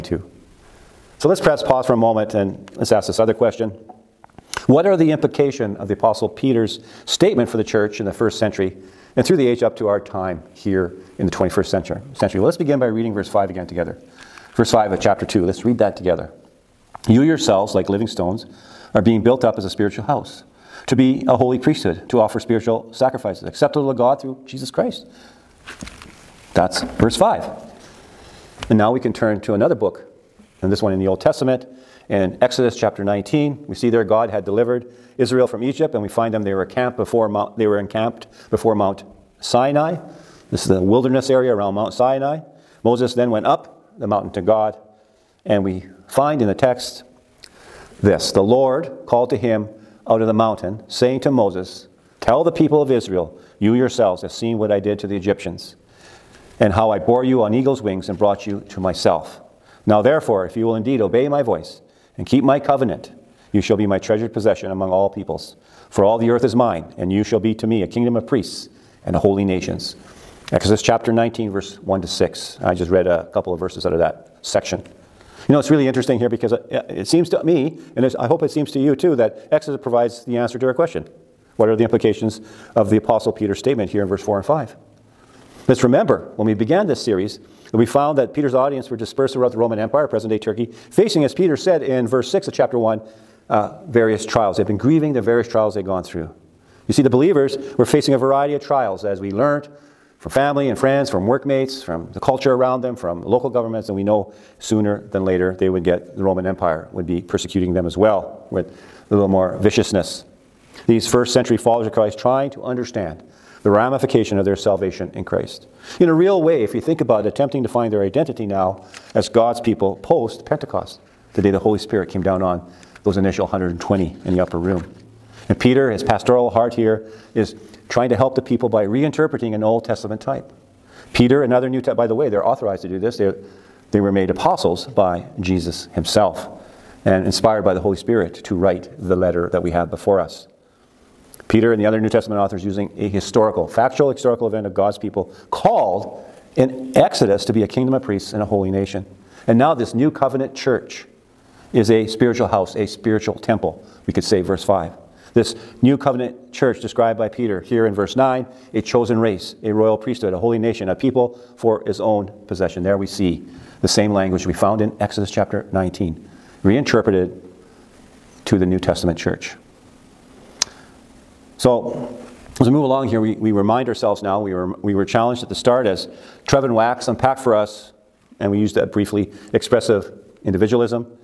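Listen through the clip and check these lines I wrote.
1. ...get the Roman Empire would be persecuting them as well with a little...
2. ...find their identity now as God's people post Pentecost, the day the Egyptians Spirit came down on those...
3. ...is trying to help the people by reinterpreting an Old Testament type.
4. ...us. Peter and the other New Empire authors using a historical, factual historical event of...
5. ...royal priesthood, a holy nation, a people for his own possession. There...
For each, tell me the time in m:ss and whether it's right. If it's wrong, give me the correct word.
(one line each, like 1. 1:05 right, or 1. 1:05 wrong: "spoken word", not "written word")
1. 1:45 right
2. 1:57 wrong: "Holy", not "Egyptians"
3. 2:07 right
4. 2:20 wrong: "Testament", not "Empire"
5. 2:39 right.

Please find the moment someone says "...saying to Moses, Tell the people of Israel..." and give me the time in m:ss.
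0:50.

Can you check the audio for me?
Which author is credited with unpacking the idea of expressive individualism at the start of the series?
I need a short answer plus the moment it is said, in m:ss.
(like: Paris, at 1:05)
Trevin Wax, at 2:56.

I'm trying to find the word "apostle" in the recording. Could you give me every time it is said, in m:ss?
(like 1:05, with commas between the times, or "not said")
0:05, 1:22, 2:14.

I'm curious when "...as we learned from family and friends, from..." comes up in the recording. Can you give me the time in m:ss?
1:39.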